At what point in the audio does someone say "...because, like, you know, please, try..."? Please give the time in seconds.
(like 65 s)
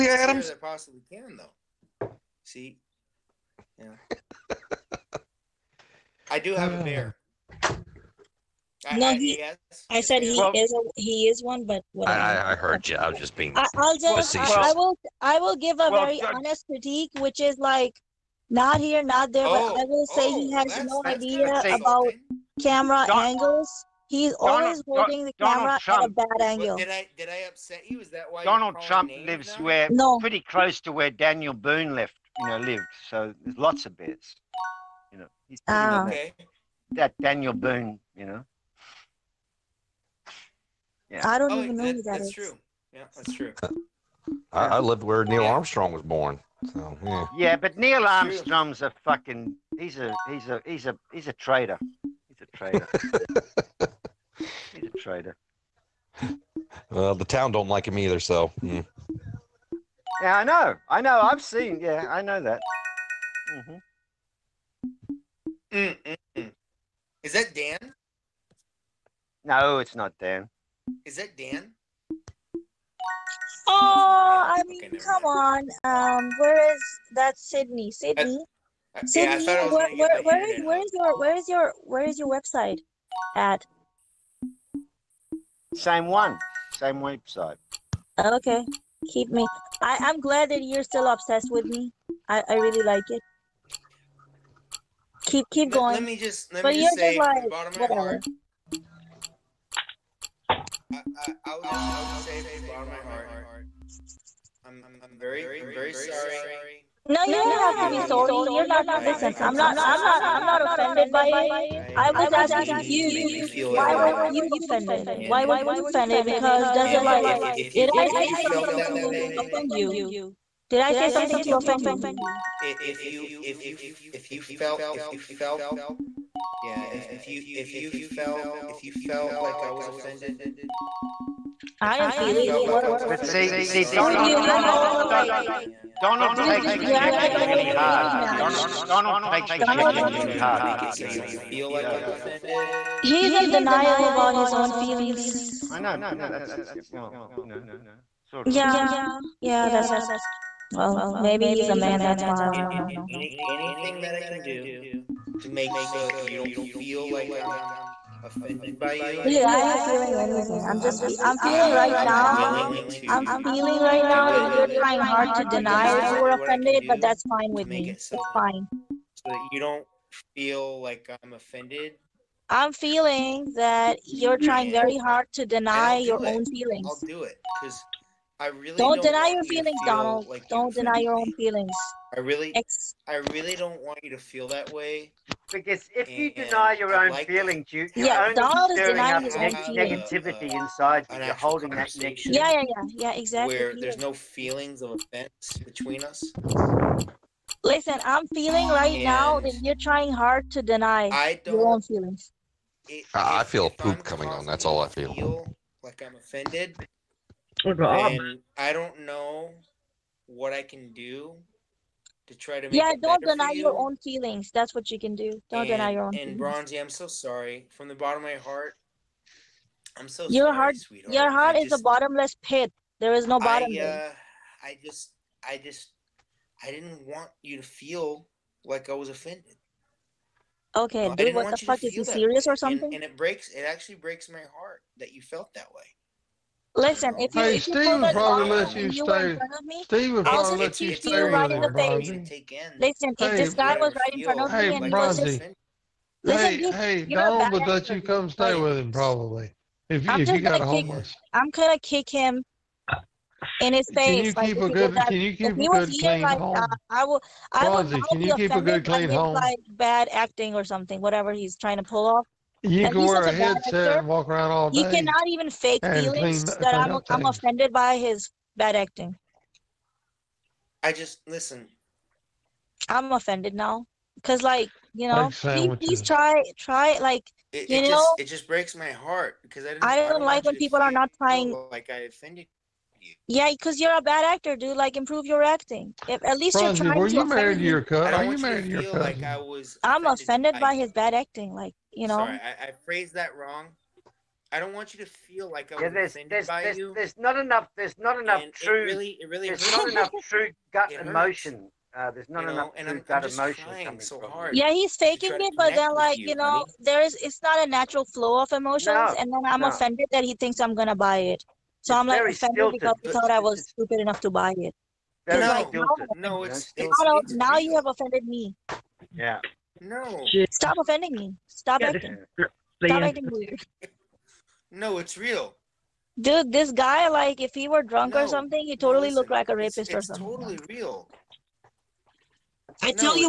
274 s.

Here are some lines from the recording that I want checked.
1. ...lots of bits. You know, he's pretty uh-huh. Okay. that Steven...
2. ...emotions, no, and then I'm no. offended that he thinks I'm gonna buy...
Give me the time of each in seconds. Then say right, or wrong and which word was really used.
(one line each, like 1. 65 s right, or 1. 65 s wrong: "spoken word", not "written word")
1. 33 s wrong: "Daniel", not "Steven"
2. 308 s right.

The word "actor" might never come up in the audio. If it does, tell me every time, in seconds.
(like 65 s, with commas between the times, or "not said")
263 s, 284 s.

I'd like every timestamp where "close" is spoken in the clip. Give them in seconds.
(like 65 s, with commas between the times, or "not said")
30 s.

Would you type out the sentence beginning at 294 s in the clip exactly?
I don't want you to feel like I yeah, was offended there's, by there's, you.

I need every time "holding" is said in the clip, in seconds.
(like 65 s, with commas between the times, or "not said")
24 s, 191 s.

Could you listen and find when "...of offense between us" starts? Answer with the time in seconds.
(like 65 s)
194 s.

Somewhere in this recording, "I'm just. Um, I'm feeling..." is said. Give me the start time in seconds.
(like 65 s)
160 s.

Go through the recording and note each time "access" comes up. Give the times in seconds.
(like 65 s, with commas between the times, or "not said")
not said.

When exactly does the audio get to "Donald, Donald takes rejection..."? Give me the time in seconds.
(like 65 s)
138 s.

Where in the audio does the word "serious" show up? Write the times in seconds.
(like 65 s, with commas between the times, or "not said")
232 s.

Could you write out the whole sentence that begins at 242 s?
Listen, if hey, this guy was right in front of hey, me and he was just.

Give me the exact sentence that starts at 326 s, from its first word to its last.
Dude, this guy, like, if he were drunk no, or something, he totally listen, looked like a rapist it's, it's or something.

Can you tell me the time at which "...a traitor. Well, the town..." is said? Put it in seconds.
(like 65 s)
54 s.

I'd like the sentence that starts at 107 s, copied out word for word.
No, you don't you have to be sorry.